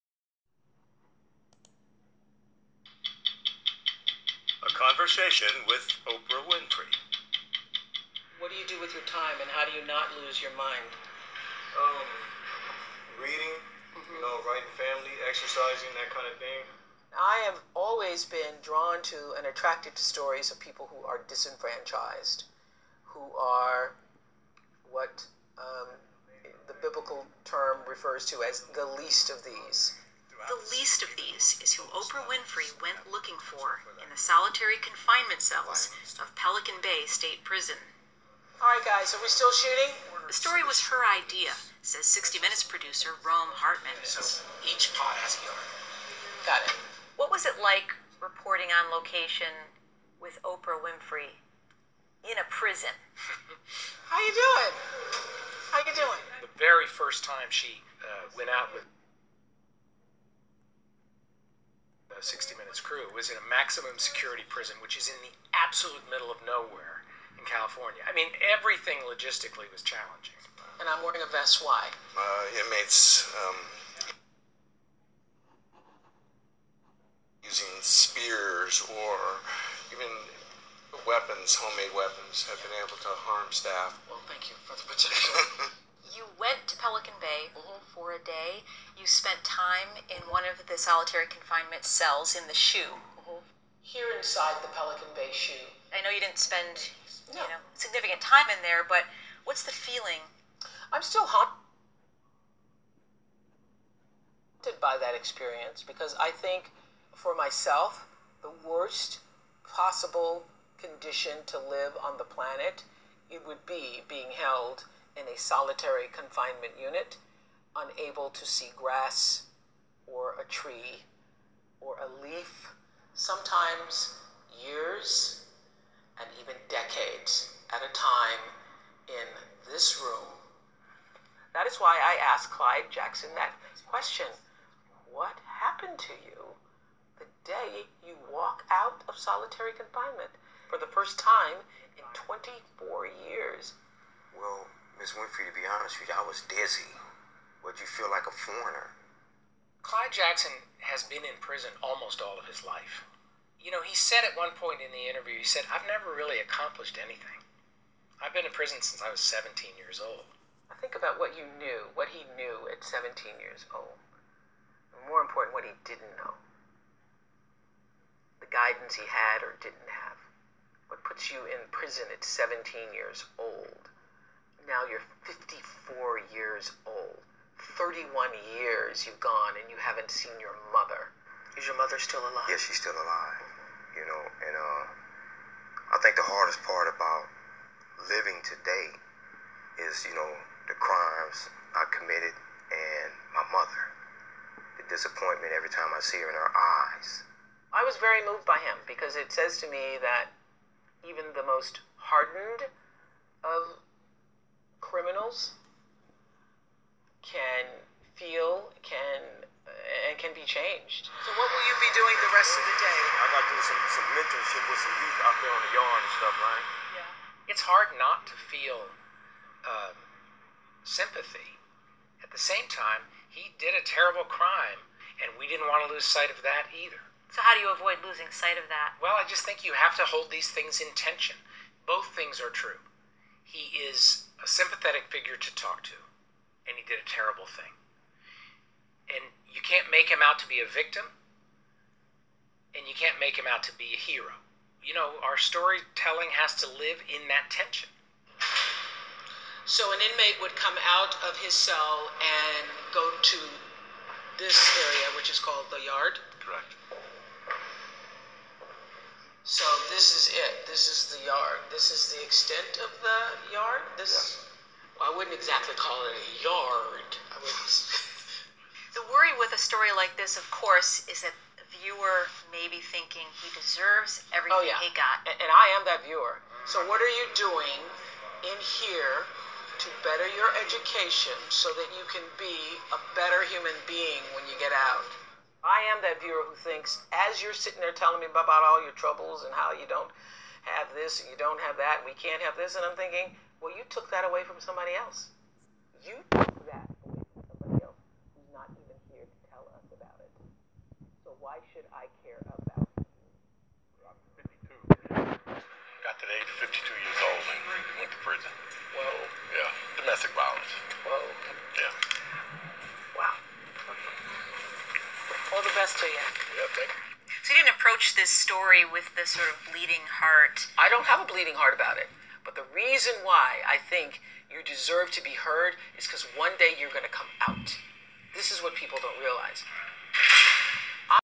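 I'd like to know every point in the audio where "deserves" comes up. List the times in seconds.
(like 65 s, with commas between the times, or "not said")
273 s, 324 s.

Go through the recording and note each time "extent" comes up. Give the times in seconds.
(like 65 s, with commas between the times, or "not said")
262 s.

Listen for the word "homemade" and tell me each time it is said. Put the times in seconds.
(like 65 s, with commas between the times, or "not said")
81 s.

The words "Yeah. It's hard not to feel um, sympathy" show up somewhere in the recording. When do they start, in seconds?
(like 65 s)
216 s.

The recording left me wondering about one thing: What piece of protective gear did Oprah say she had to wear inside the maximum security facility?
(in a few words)
A vest.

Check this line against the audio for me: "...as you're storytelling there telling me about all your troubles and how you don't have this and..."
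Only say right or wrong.
wrong.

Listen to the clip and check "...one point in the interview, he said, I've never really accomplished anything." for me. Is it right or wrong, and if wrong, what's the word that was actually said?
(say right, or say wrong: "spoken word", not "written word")
right.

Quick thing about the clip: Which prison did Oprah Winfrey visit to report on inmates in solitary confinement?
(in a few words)
Pelican Bay State Prison.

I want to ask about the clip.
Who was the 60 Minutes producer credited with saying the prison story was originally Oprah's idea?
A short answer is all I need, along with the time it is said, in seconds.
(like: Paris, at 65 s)
Rome Hartman, at 43 s.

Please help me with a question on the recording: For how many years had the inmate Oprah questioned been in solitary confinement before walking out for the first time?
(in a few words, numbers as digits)
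24.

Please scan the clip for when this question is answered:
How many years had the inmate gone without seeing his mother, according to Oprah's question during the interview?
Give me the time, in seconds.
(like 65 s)
177 s.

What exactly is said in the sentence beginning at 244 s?
You know, our storytelling has to live in that tension.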